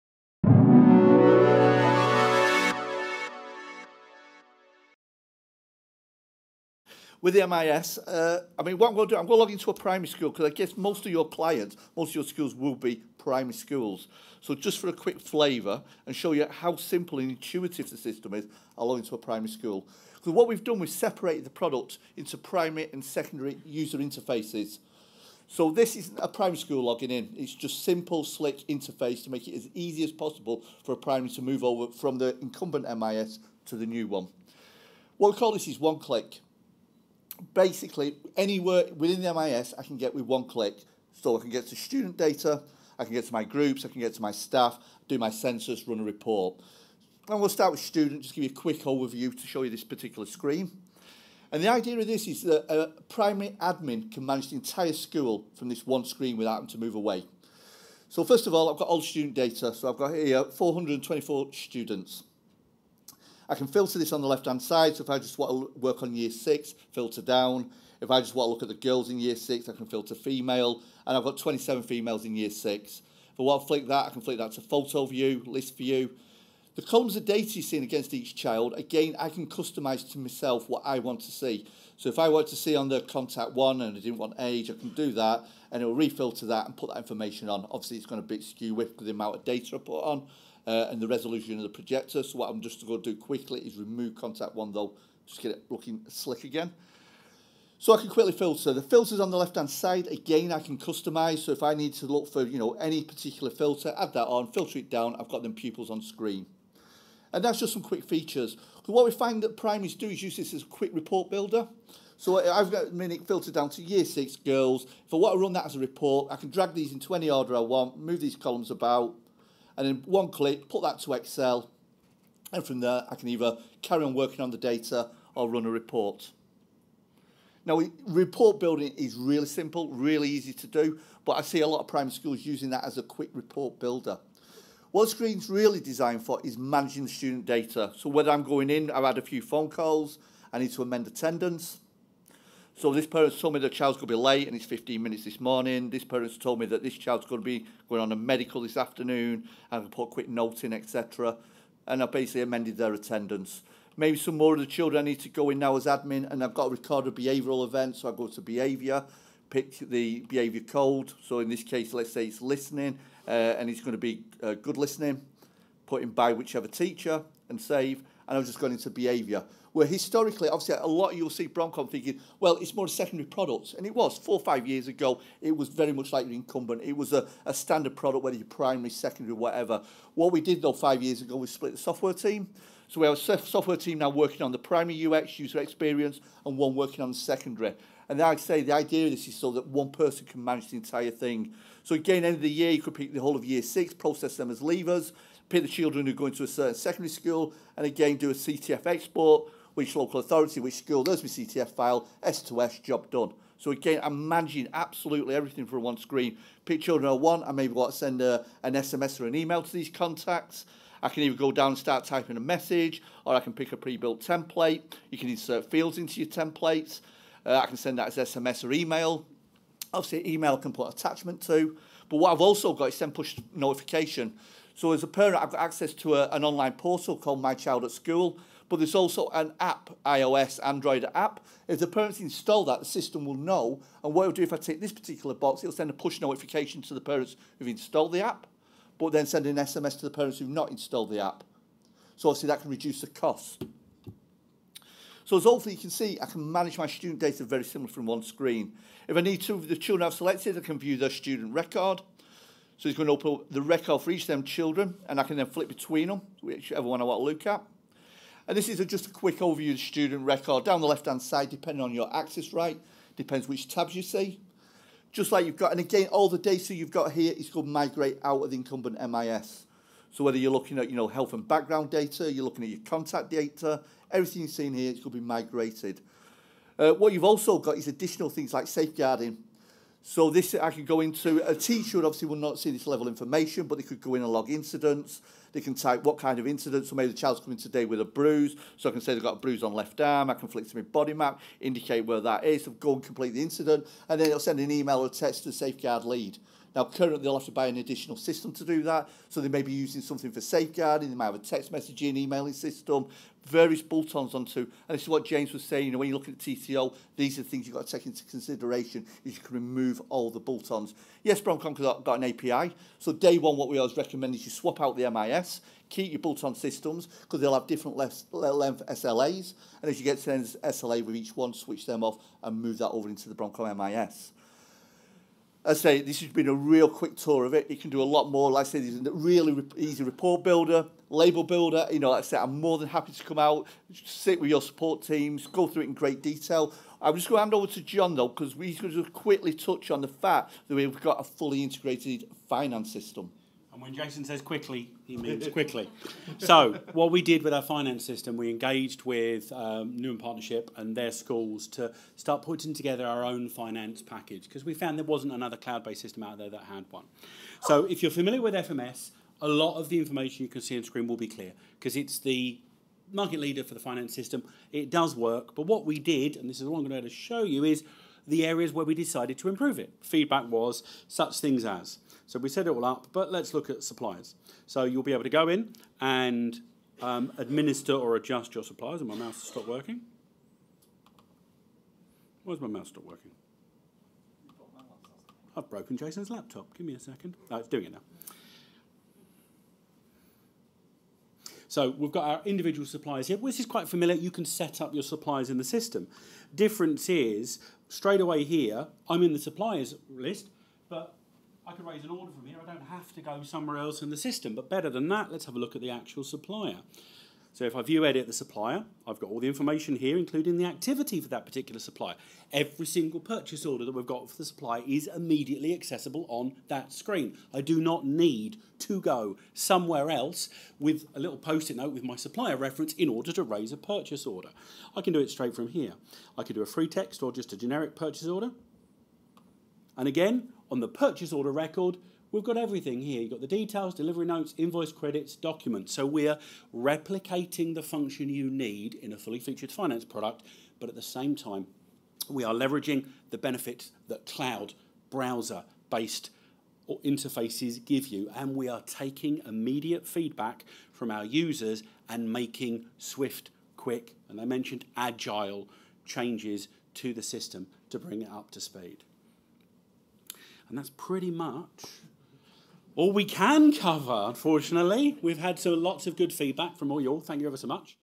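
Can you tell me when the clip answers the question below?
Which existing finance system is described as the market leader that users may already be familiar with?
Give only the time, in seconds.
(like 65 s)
358 s.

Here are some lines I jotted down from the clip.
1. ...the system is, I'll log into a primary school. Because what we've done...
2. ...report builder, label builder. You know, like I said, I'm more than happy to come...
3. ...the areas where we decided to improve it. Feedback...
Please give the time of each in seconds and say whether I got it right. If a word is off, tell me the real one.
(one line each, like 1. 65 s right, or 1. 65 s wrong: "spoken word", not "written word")
1. 17 s right
2. 330 s right
3. 368 s right.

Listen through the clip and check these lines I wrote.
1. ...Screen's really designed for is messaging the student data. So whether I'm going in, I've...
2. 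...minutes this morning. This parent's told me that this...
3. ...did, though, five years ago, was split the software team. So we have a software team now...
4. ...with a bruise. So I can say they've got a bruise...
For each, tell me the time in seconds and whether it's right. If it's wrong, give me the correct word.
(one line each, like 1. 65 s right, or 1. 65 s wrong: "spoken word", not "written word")
1. 135 s wrong: "managing", not "messaging"
2. 145 s right
3. 180 s right
4. 287 s right.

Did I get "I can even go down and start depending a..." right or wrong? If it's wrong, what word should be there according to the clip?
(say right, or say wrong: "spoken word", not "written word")
wrong: "typing", not "depending".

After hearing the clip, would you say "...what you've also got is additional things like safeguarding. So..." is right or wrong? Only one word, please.
right.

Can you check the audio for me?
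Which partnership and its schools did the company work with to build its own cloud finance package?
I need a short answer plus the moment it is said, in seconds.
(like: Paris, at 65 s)
Newham Partnership, at 349 s.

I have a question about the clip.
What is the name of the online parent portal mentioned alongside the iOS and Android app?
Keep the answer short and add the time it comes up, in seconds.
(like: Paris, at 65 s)
My Child at School, at 227 s.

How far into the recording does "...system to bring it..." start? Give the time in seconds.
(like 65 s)
457 s.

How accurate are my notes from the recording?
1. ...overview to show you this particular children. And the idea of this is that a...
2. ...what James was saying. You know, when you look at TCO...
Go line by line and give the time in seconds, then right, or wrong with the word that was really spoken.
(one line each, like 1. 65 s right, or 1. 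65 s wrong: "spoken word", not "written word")
1. 48 s wrong: "screen", not "children"
2. 305 s right.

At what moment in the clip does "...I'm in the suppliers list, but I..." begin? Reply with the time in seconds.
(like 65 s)
399 s.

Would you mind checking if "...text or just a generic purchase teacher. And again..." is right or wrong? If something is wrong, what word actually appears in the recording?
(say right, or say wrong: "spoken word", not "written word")
wrong: "order", not "teacher".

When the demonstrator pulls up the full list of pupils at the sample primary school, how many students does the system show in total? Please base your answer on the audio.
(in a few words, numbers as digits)
424.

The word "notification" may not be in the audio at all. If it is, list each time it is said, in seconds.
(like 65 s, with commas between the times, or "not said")
223 s, 236 s.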